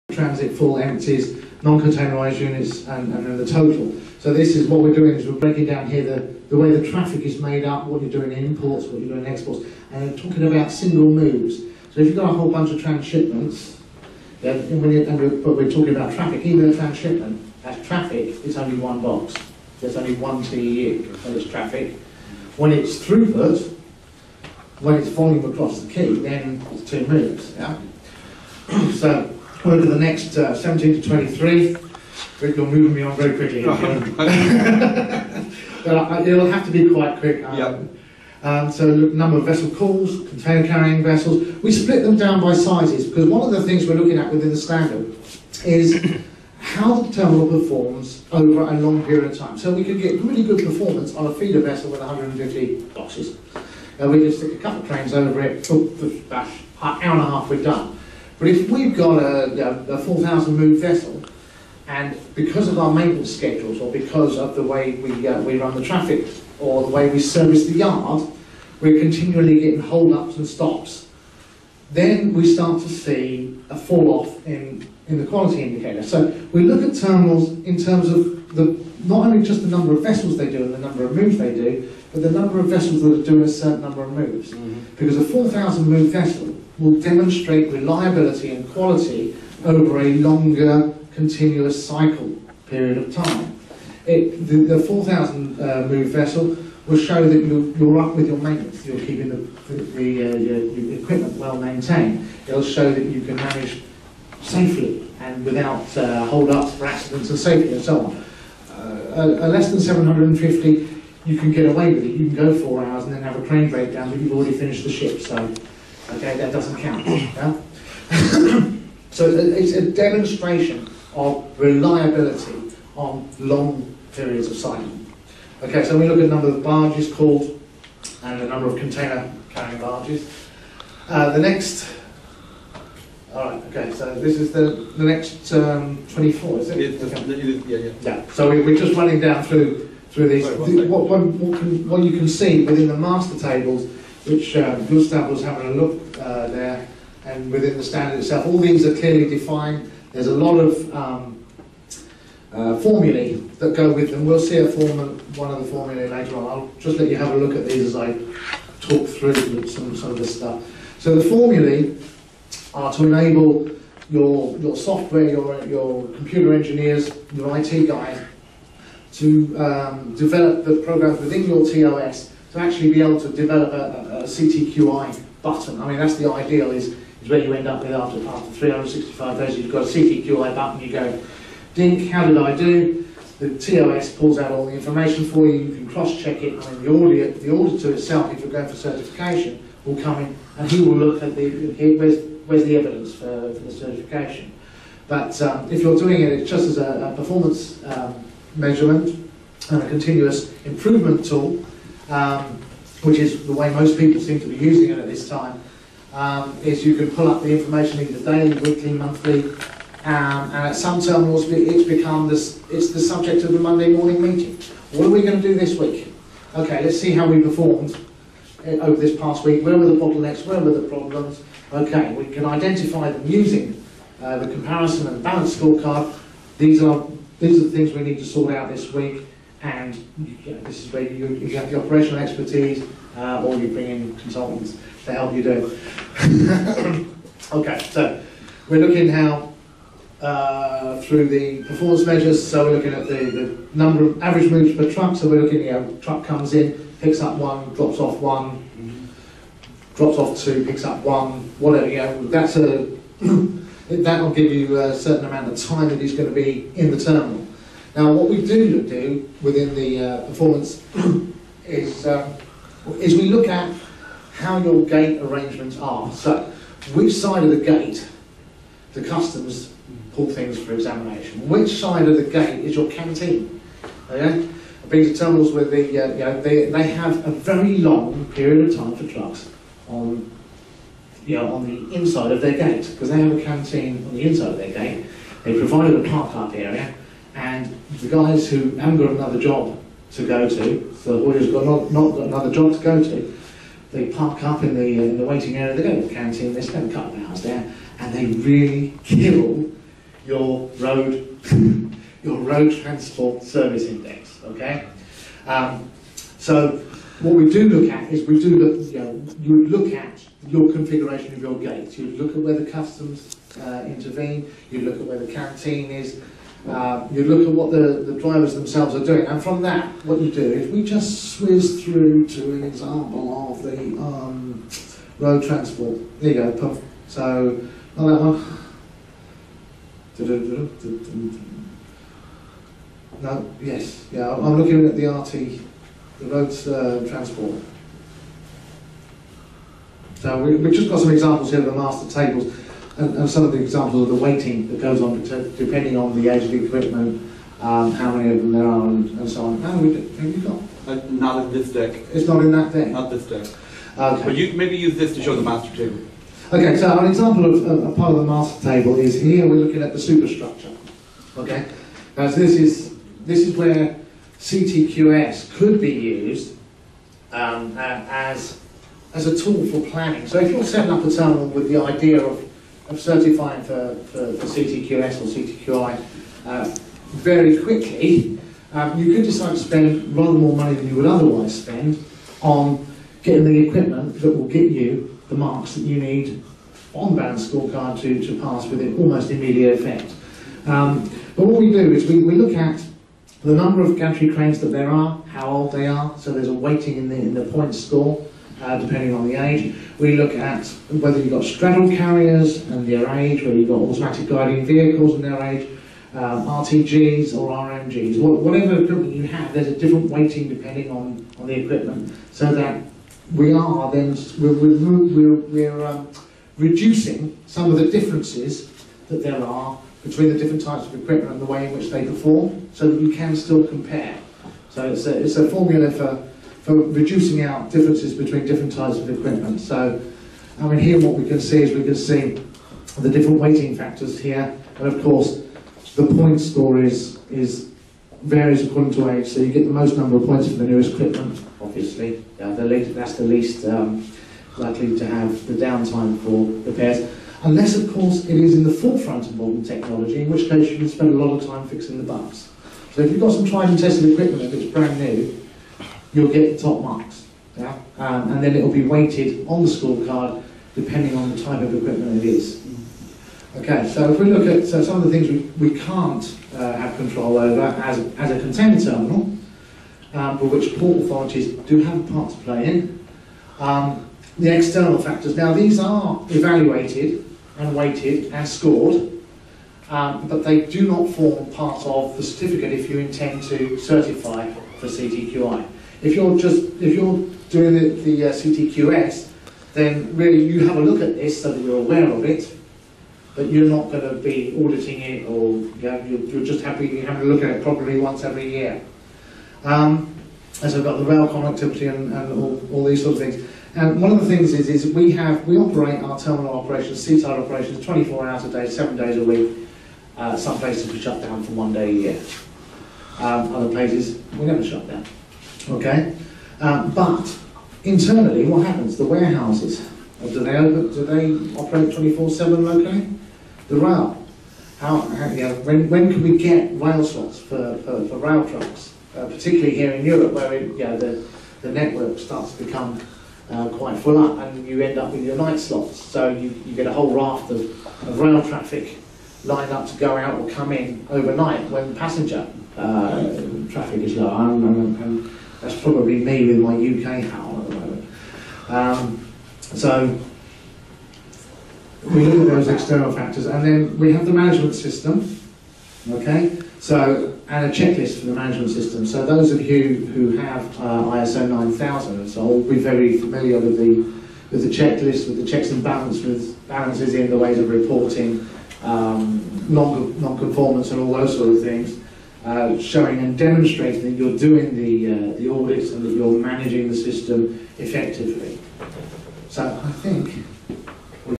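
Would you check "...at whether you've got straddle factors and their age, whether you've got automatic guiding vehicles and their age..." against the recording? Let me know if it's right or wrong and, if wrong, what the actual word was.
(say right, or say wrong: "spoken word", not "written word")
wrong: "carriers", not "factors".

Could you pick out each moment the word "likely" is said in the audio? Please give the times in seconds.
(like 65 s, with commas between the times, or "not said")
444 s.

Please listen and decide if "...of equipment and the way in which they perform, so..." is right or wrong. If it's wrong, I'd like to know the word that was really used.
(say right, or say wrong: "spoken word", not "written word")
right.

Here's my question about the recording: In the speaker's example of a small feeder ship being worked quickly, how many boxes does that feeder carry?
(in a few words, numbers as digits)
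150.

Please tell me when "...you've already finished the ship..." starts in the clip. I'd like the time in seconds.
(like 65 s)
114 s.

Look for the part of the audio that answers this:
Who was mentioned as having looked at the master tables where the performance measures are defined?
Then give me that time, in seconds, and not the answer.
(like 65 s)
144 s.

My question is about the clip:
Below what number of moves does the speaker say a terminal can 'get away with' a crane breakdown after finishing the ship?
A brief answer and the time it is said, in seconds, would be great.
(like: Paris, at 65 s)
750, at 109 s.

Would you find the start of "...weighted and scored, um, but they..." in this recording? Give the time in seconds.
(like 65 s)
477 s.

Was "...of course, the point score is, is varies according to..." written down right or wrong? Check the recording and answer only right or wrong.
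right.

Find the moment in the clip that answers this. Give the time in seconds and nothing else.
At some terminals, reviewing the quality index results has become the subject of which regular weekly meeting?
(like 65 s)
213 s.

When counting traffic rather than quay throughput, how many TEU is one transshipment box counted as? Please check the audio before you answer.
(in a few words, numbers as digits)
1.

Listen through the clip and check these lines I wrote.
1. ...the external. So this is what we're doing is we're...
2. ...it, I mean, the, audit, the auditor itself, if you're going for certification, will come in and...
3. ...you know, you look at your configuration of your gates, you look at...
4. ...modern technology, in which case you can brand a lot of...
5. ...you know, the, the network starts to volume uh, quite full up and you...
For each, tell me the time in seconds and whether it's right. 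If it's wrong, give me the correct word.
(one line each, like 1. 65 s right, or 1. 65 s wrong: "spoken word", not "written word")
1. 3 s wrong: "total", not "external"
2. 186 s right
3. 308 s right
4. 449 s wrong: "spend", not "brand"
5. 530 s wrong: "become", not "volume".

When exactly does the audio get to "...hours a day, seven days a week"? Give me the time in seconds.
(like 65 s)
508 s.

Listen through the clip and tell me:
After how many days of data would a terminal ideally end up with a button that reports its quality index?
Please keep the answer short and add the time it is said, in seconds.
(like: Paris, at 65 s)
365, at 178 s.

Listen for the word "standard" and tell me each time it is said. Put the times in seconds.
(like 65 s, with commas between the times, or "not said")
44 s, 147 s.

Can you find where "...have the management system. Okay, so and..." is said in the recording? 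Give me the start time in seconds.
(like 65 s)
554 s.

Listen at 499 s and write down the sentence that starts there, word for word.
Um, so we've got the rail connectivity and, and all, all, these sort of things.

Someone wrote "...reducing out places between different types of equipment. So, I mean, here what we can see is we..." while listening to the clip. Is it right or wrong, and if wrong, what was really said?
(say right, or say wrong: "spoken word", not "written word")
wrong: "differences", not "places".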